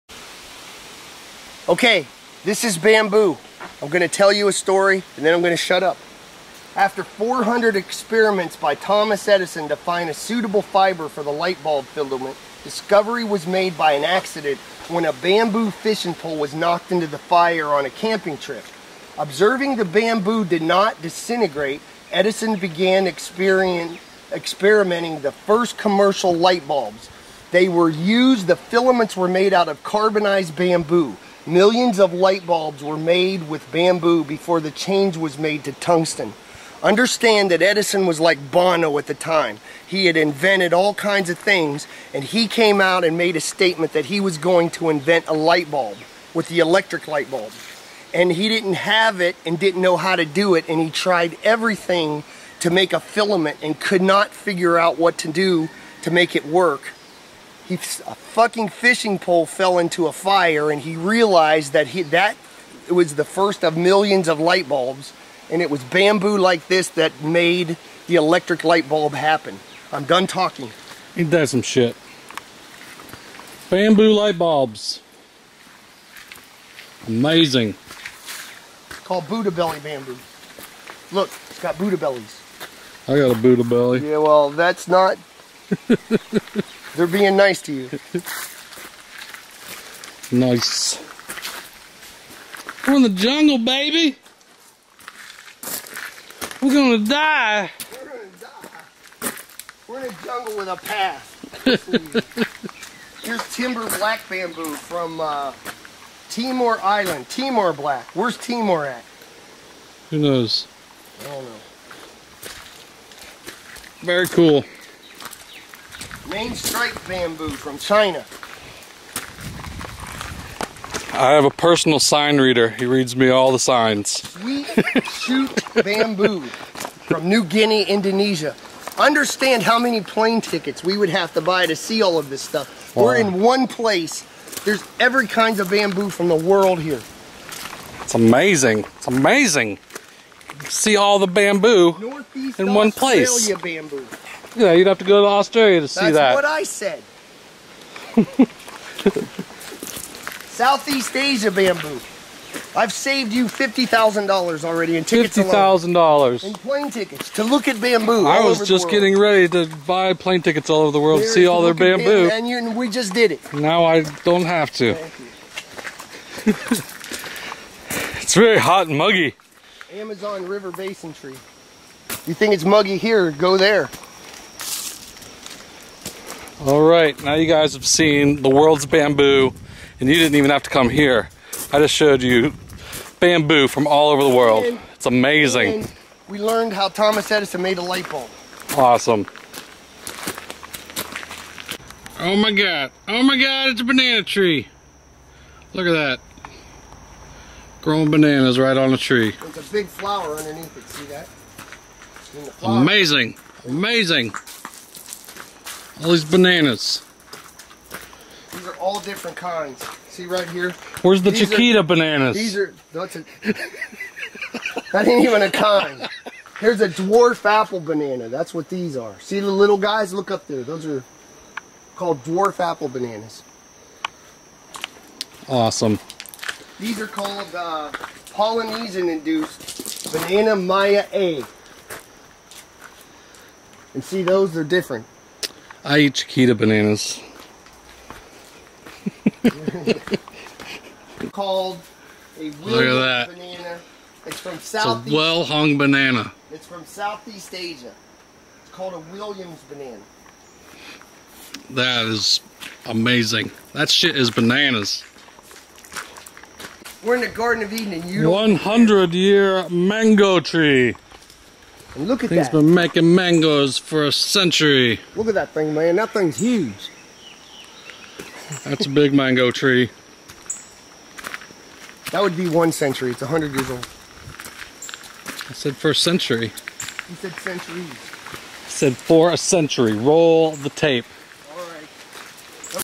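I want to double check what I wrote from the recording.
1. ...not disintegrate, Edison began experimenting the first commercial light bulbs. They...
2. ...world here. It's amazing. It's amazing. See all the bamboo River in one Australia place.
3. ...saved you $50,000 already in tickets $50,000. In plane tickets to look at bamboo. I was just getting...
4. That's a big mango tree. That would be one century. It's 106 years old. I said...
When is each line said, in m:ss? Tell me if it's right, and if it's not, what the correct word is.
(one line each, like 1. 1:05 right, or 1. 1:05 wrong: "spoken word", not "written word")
1. 0:20 right
2. 2:16 wrong: "Northeast", not "River"
3. 2:32 right
4. 4:28 wrong: "100", not "106".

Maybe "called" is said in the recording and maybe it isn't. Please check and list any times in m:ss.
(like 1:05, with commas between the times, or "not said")
1:19, 3:41, 3:47, 4:01, 4:08.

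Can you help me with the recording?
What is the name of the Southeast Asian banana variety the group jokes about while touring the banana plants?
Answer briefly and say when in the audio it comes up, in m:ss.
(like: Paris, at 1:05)
Williams banana, at 4:09.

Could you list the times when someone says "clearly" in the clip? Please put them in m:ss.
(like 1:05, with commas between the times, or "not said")
not said.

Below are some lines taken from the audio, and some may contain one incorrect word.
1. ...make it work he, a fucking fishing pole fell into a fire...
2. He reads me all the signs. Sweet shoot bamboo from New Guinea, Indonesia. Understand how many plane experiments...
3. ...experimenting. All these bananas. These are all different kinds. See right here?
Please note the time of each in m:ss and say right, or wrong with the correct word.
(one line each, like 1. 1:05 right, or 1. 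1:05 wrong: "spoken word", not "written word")
1. 0:56 right
2. 2:02 wrong: "tickets", not "experiments"
3. 3:23 wrong: "amazing", not "experimenting".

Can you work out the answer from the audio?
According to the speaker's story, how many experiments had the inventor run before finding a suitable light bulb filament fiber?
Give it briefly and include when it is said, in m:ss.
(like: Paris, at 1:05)
400, at 0:07.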